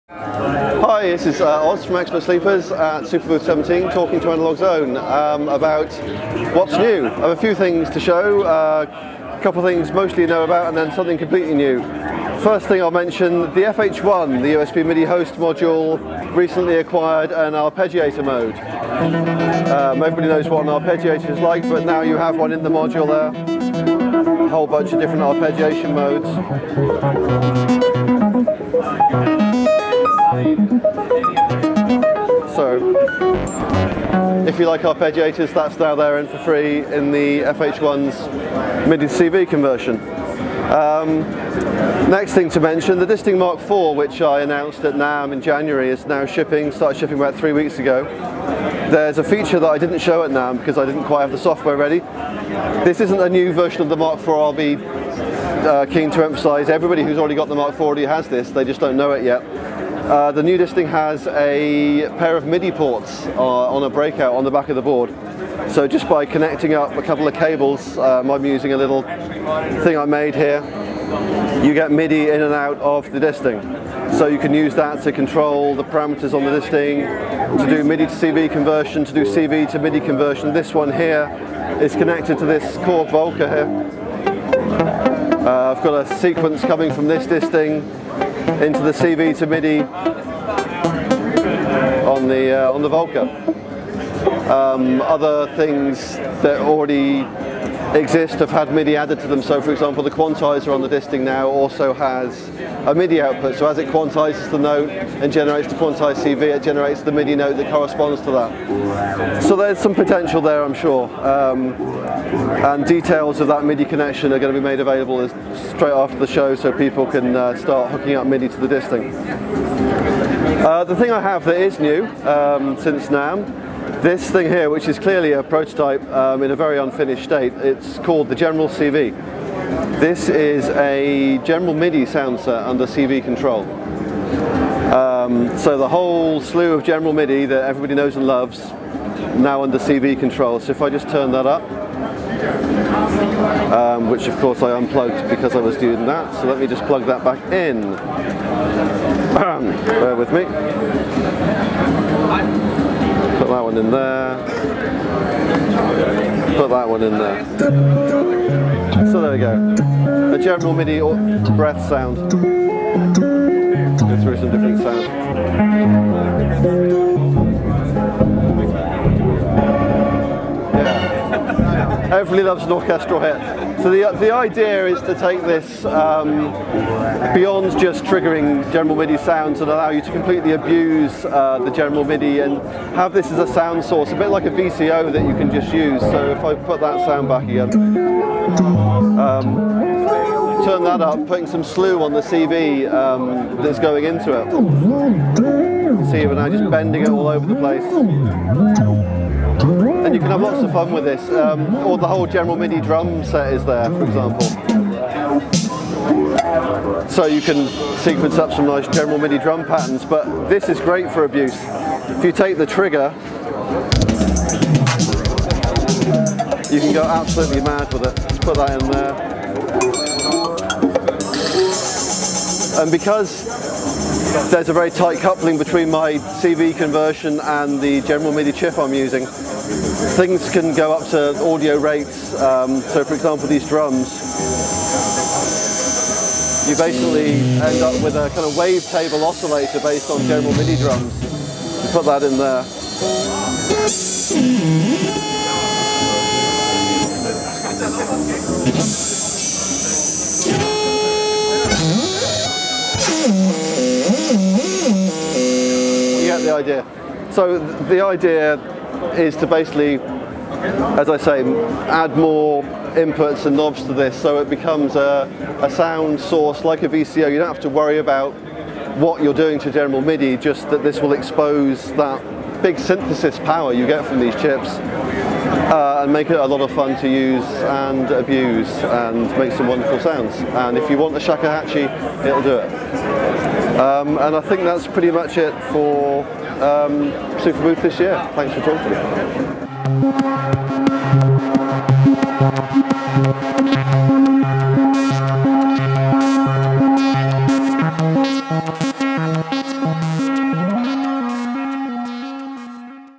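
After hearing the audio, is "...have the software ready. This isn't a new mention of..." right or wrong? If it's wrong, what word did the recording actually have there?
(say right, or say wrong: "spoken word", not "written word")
wrong: "version", not "mention".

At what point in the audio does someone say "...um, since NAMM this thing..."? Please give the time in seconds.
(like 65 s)
122 s.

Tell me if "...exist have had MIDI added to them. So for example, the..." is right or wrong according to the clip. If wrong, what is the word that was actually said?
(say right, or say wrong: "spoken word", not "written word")
right.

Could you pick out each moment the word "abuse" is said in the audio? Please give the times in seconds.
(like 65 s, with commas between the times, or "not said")
180 s, 211 s, 278 s.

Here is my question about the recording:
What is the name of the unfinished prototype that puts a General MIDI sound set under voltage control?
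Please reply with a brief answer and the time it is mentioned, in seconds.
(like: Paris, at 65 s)
General CV, at 128 s.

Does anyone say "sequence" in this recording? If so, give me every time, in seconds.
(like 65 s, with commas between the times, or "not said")
86 s, 207 s.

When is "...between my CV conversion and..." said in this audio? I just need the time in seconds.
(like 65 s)
225 s.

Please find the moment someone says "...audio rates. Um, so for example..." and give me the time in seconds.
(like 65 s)
231 s.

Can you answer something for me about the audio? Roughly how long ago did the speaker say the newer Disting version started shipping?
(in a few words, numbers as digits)
About 3 weeks.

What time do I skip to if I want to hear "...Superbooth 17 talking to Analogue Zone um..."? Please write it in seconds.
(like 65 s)
3 s.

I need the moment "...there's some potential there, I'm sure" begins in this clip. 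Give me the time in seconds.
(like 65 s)
109 s.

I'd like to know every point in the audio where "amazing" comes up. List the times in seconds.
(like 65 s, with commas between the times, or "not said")
not said.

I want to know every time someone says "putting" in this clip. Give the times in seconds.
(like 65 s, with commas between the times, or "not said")
191 s.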